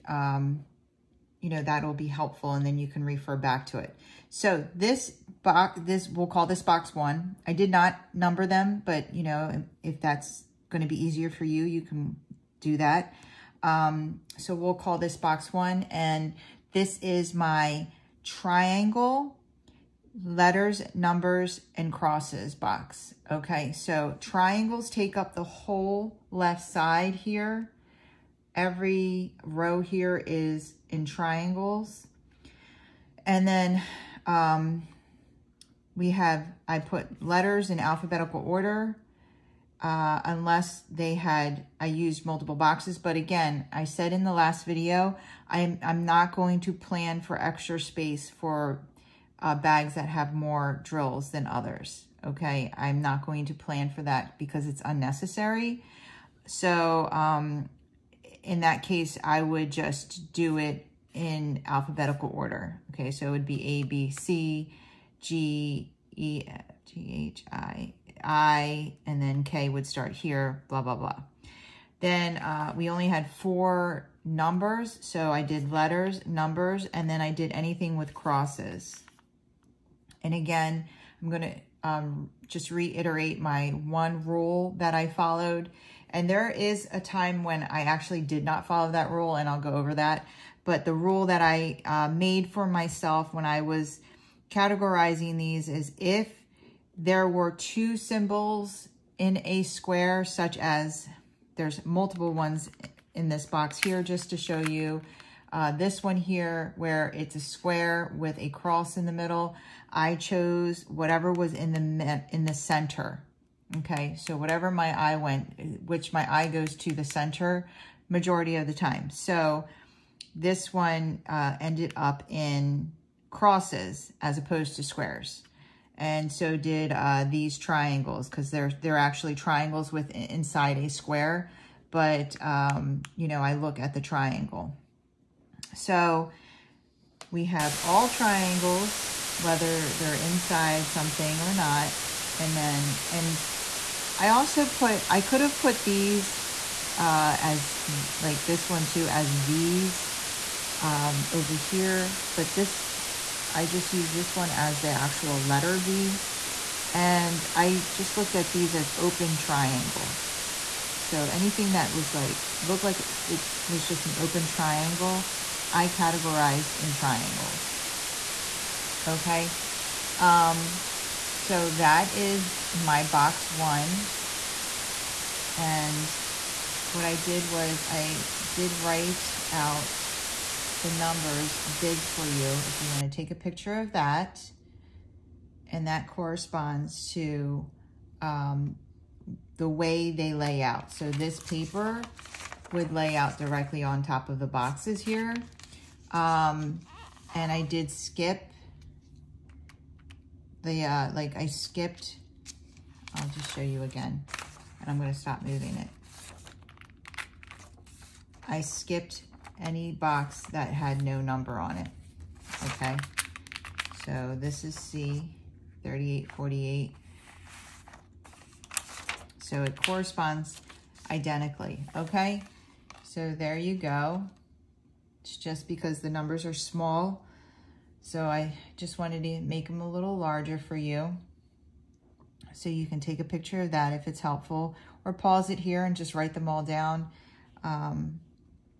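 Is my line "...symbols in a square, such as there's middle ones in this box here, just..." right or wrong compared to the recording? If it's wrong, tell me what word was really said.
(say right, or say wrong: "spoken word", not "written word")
wrong: "multiple", not "middle".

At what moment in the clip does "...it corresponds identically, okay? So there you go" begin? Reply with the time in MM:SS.
03:39.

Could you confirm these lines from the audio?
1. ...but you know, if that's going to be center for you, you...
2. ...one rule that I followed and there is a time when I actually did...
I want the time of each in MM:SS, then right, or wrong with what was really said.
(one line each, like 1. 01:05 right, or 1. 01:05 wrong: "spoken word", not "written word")
1. 00:08 wrong: "easier", not "center"
2. 01:23 right.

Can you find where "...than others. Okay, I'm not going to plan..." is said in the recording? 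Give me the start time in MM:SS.
00:51.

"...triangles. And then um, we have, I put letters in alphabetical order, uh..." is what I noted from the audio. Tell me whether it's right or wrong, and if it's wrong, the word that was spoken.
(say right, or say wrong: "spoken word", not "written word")
right.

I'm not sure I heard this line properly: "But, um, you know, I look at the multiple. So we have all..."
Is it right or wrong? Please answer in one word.
wrong.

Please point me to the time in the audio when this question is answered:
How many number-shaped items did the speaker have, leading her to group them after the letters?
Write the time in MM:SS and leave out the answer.
01:12.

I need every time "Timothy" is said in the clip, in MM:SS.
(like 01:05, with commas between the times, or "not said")
not said.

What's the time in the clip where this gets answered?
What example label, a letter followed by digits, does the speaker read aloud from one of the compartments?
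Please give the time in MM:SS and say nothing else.
03:34.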